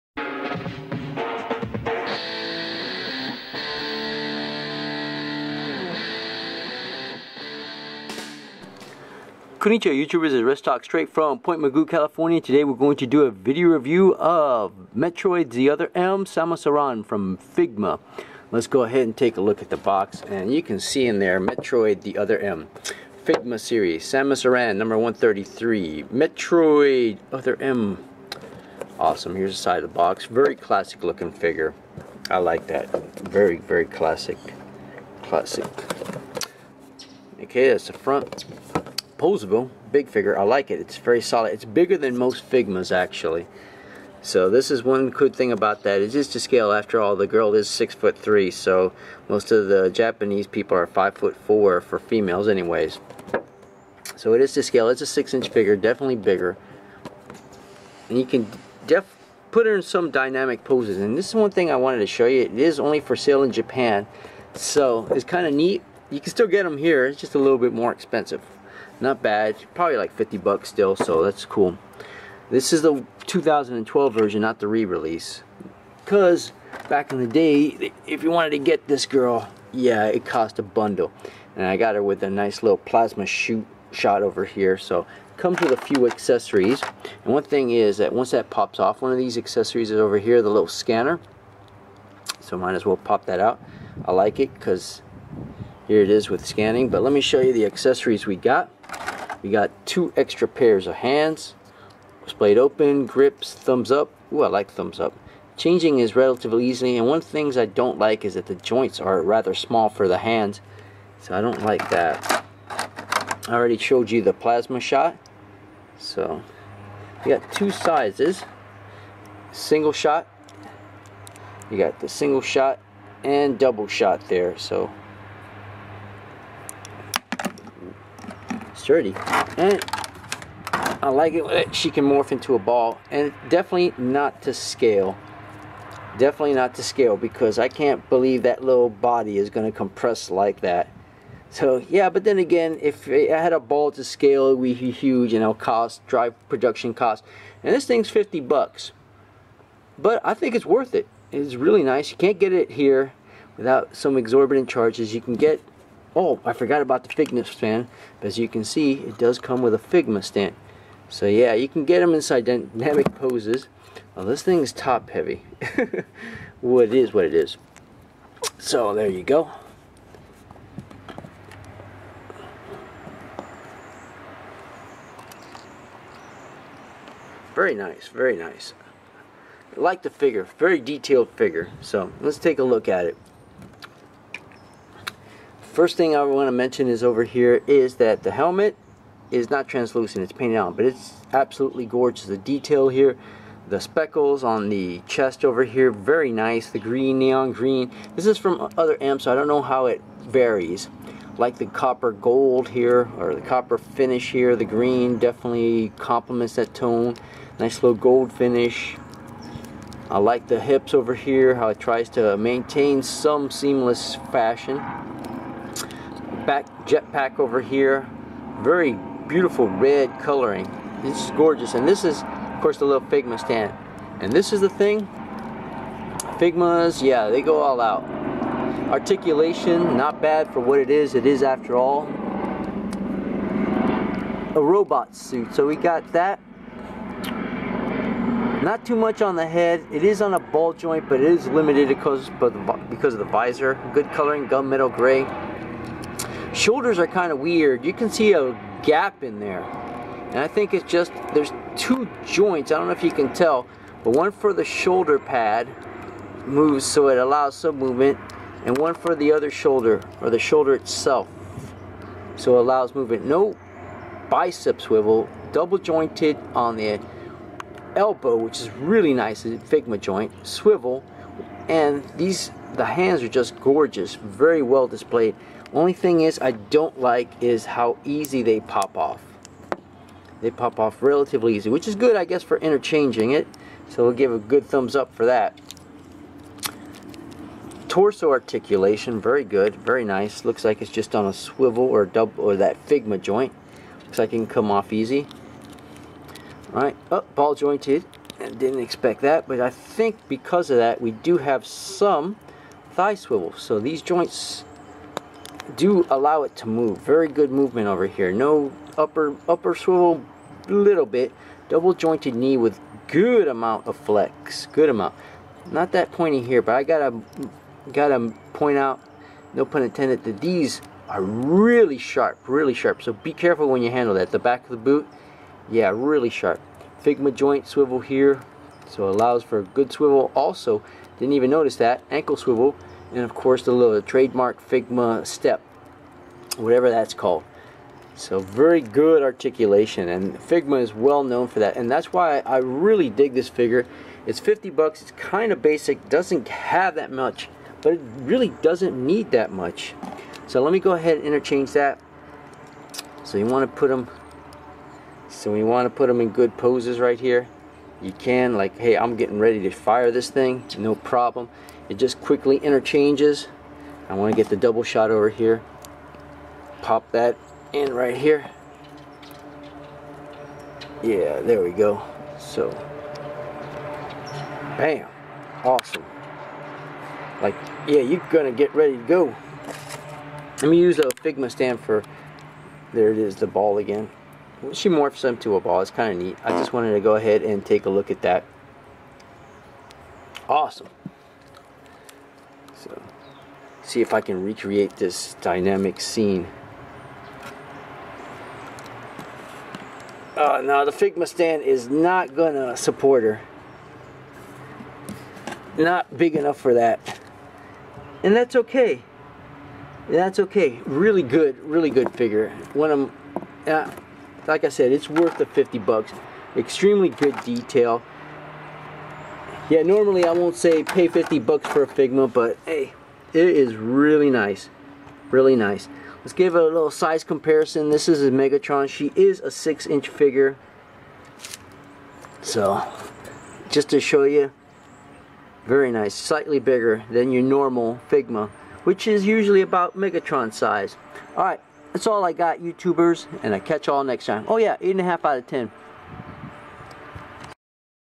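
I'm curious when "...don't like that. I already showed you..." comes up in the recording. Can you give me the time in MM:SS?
01:51.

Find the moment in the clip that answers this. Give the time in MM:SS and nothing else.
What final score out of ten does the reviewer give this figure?
07:24.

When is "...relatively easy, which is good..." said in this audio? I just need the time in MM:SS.
04:41.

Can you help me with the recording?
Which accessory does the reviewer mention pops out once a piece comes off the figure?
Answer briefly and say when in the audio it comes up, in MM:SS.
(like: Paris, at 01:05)
scanner, at 01:30.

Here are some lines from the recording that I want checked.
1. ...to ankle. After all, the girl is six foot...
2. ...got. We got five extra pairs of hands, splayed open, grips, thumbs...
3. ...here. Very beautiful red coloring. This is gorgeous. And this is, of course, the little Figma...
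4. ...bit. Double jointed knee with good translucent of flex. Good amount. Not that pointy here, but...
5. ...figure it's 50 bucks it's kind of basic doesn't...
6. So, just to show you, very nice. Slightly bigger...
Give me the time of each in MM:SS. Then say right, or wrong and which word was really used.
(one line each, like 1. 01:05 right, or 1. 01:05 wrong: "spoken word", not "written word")
1. 00:46 wrong: "scale", not "ankle"
2. 01:38 wrong: "two", not "five"
3. 03:37 right
4. 05:11 wrong: "amount", not "translucent"
5. 05:43 right
6. 07:12 right.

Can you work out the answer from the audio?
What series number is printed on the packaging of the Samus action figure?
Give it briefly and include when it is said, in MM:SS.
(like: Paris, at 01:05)
133, at 00:24.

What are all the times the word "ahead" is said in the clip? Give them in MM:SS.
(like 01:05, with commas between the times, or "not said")
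00:18, 05:50, 06:27.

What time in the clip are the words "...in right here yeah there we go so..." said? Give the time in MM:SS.
06:07.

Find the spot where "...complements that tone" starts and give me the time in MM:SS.
03:25.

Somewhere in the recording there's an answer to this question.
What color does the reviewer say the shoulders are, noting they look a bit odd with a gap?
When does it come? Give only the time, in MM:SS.
04:04.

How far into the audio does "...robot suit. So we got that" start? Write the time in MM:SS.
03:54.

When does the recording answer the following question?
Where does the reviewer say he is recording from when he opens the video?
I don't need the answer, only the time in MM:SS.
00:11.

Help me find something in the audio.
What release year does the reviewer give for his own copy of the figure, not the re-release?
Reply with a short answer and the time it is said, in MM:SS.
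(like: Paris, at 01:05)
2012, at 01:13.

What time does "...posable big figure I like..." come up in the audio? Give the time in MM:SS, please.
00:39.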